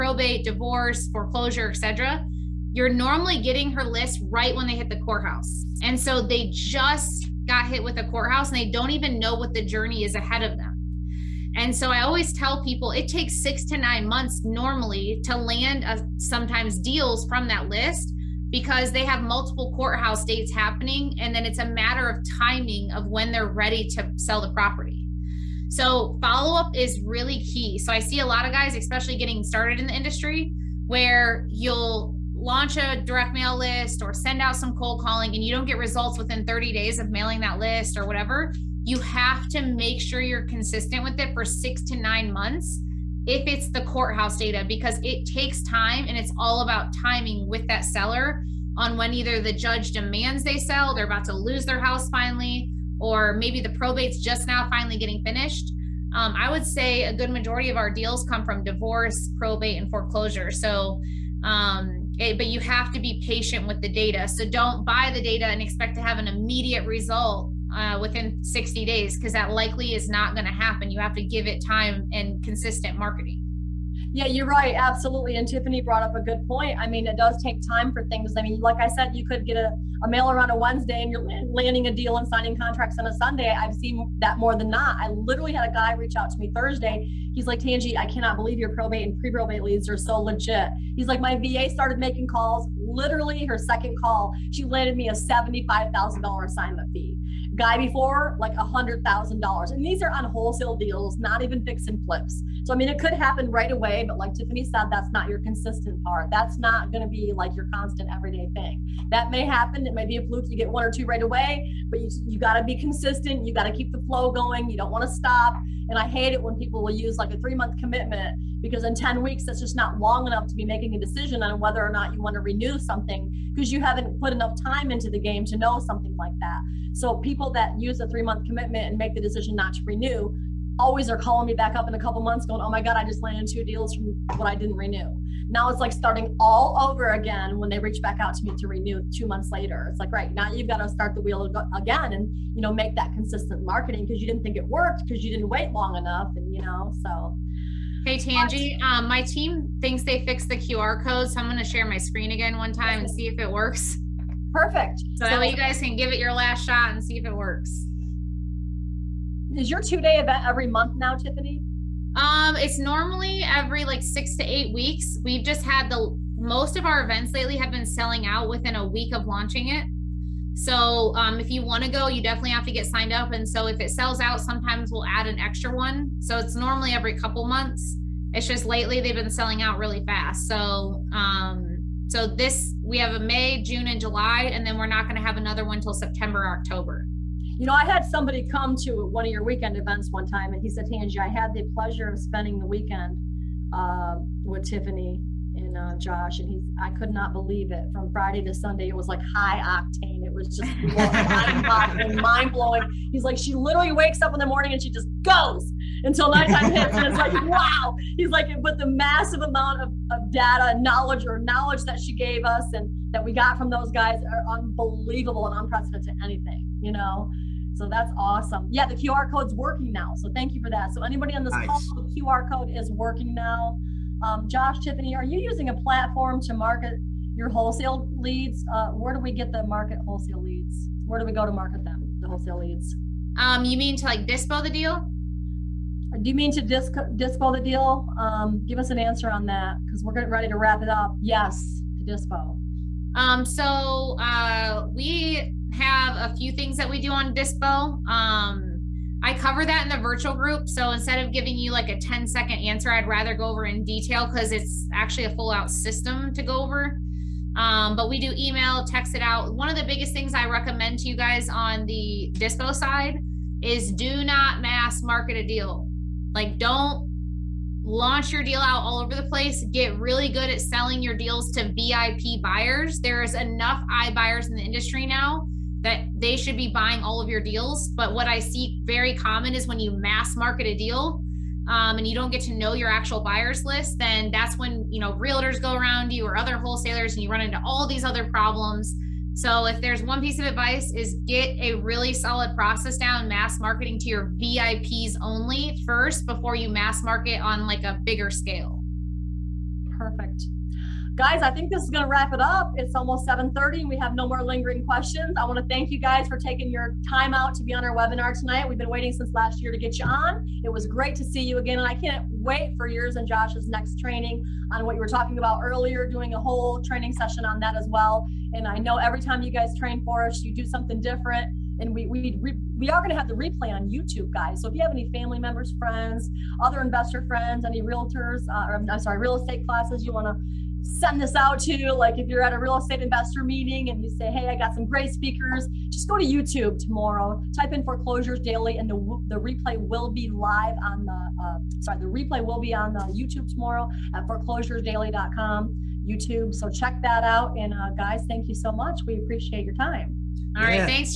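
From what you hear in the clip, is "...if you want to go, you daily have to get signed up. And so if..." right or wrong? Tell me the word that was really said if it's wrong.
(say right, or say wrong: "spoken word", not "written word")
wrong: "definitely", not "daily".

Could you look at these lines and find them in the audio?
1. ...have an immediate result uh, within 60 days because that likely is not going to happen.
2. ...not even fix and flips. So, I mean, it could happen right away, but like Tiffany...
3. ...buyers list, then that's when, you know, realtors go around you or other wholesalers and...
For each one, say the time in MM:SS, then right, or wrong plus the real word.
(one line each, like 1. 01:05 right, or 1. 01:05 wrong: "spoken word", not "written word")
1. 01:06 right
2. 01:41 right
3. 04:43 right.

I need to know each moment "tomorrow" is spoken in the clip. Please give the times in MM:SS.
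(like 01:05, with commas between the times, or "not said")
05:36, 05:43.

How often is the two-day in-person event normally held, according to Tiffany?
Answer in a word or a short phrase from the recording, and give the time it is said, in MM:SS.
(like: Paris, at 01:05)
Every 6 to 8 weeks, at 02:43.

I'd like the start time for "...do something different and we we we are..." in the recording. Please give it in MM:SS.
05:20.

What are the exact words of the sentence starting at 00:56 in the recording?
Um, I would say a good majority of our deals come from divorce, probate, and foreclosure.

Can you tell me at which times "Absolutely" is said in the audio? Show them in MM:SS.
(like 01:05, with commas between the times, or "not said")
01:14.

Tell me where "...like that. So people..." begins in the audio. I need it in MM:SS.
02:06.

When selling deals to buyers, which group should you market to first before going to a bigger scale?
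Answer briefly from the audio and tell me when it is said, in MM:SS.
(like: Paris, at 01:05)
VIP buyers, at 04:54.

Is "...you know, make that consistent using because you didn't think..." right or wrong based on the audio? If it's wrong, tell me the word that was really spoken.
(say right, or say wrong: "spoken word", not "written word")
wrong: "marketing", not "using".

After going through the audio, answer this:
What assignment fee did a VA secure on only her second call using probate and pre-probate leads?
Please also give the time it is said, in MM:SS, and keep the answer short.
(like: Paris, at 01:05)
$75,000, at 01:35.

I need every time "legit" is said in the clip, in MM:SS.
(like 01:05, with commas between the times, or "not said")
01:30.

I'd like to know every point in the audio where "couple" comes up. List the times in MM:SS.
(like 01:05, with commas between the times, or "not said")
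02:11, 02:57.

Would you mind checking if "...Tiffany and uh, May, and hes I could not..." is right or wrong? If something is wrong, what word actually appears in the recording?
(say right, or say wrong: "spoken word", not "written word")
wrong: "Josh", not "May".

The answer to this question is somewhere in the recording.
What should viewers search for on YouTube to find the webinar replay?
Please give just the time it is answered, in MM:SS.
05:37.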